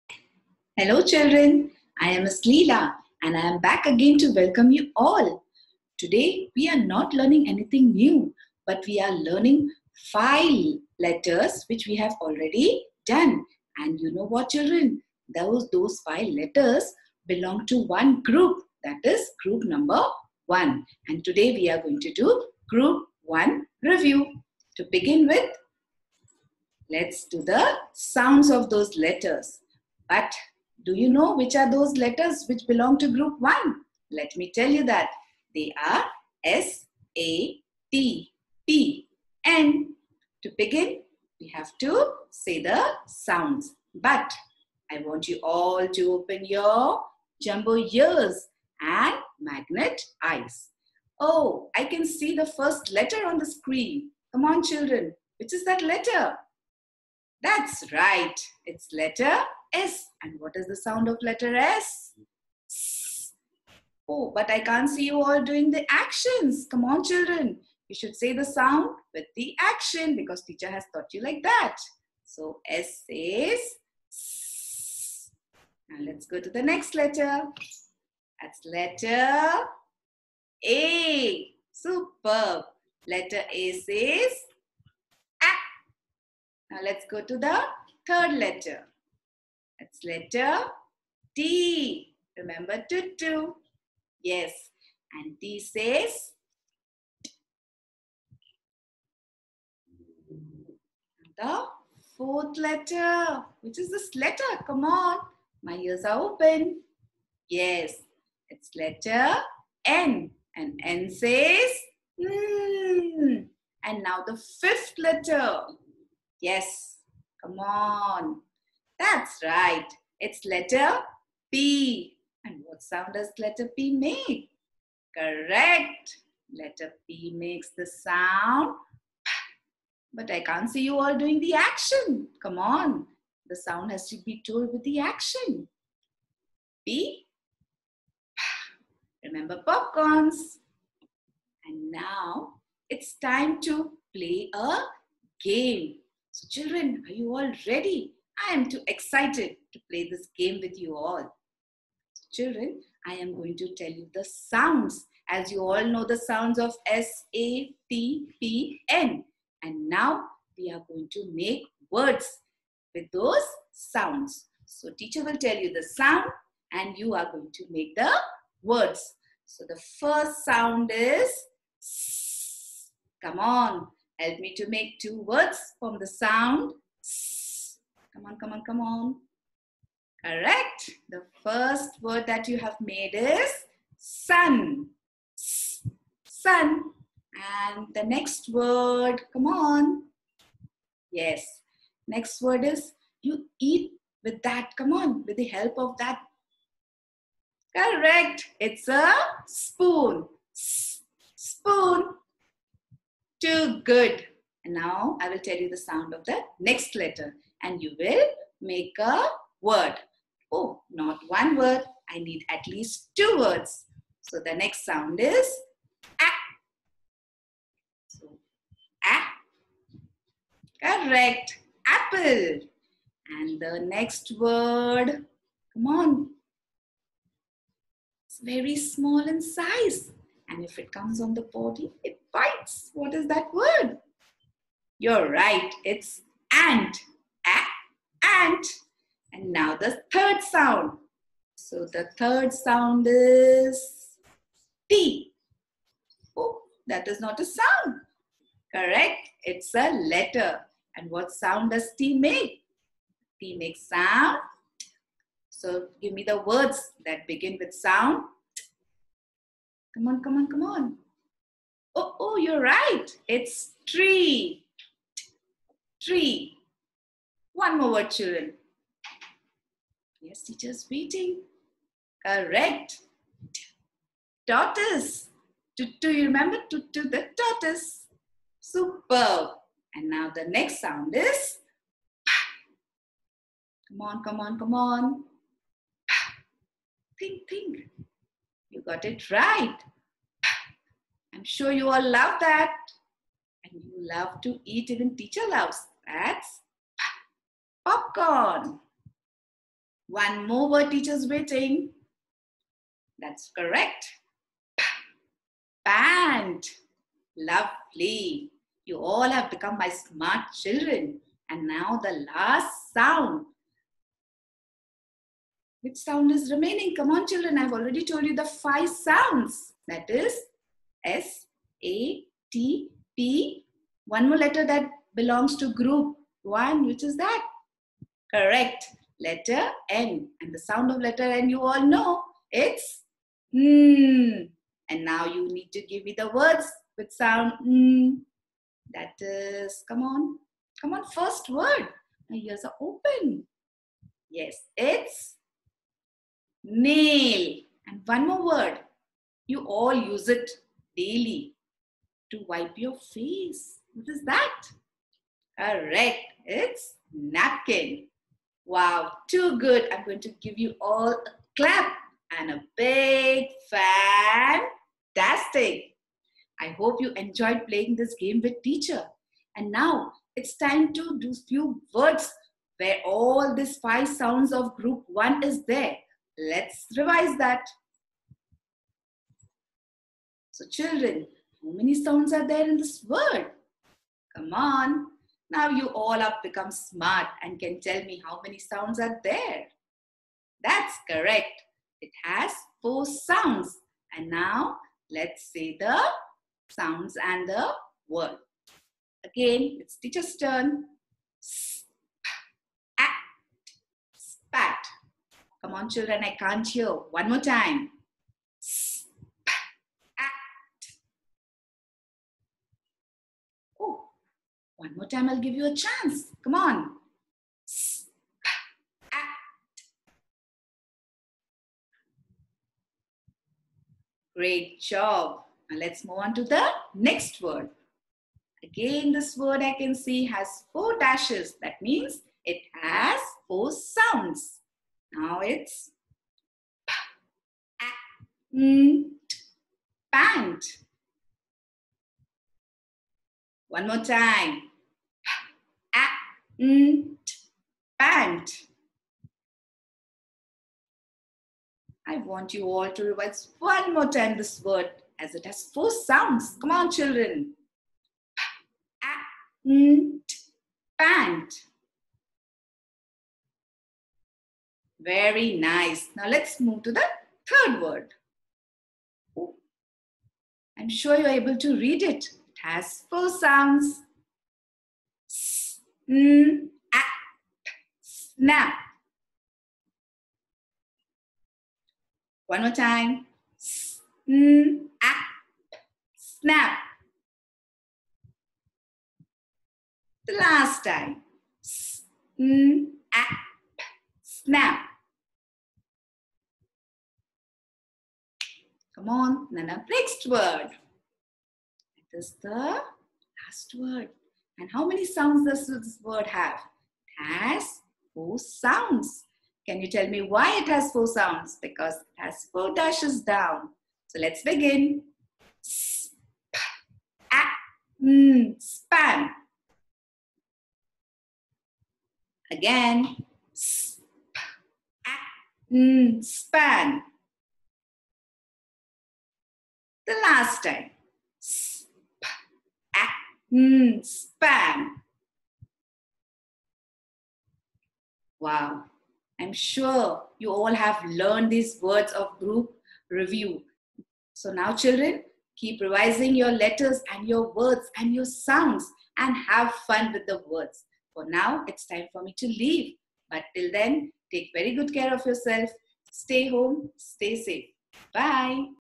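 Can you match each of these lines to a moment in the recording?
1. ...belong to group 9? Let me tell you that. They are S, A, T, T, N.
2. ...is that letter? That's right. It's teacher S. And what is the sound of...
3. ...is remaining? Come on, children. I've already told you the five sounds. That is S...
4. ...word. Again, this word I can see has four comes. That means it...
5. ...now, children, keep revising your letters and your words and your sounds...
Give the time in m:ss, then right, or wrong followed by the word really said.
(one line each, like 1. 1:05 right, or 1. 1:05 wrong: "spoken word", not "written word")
1. 0:32 wrong: "1", not "9"
2. 0:55 wrong: "letter", not "teacher"
3. 5:16 right
4. 7:07 wrong: "dashes", not "comes"
5. 9:04 right.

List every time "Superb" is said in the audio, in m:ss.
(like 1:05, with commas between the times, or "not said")
1:21, 4:38.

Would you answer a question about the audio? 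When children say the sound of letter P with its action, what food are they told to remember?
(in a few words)
Popcorns.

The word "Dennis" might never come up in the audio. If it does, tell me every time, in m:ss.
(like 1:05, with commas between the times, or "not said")
not said.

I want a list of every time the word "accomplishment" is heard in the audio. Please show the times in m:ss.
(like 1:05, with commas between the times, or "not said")
not said.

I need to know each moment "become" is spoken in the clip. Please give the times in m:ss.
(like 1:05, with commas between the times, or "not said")
5:09, 6:26.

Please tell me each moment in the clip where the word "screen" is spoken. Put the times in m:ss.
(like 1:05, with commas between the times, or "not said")
0:53.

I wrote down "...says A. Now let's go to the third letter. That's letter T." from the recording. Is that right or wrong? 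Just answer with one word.
right.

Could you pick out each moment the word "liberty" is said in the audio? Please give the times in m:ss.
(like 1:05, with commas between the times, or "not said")
not said.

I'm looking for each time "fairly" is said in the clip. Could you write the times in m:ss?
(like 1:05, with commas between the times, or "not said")
not said.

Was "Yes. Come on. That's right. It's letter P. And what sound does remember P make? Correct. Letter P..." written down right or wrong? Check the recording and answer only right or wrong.
wrong.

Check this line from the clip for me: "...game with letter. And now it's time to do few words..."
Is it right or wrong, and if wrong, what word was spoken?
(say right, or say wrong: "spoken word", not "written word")
wrong: "teacher", not "letter".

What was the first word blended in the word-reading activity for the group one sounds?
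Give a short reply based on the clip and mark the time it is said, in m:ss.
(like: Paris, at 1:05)
Spat, at 6:41.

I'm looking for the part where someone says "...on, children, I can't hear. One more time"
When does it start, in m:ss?
6:45.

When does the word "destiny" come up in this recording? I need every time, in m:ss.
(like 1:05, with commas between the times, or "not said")
not said.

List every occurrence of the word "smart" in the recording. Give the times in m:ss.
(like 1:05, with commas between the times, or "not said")
5:09, 6:26.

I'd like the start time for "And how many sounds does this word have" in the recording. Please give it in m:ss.
8:24.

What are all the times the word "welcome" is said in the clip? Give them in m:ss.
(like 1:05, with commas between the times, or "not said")
0:04.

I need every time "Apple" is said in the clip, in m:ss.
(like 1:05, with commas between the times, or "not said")
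3:41.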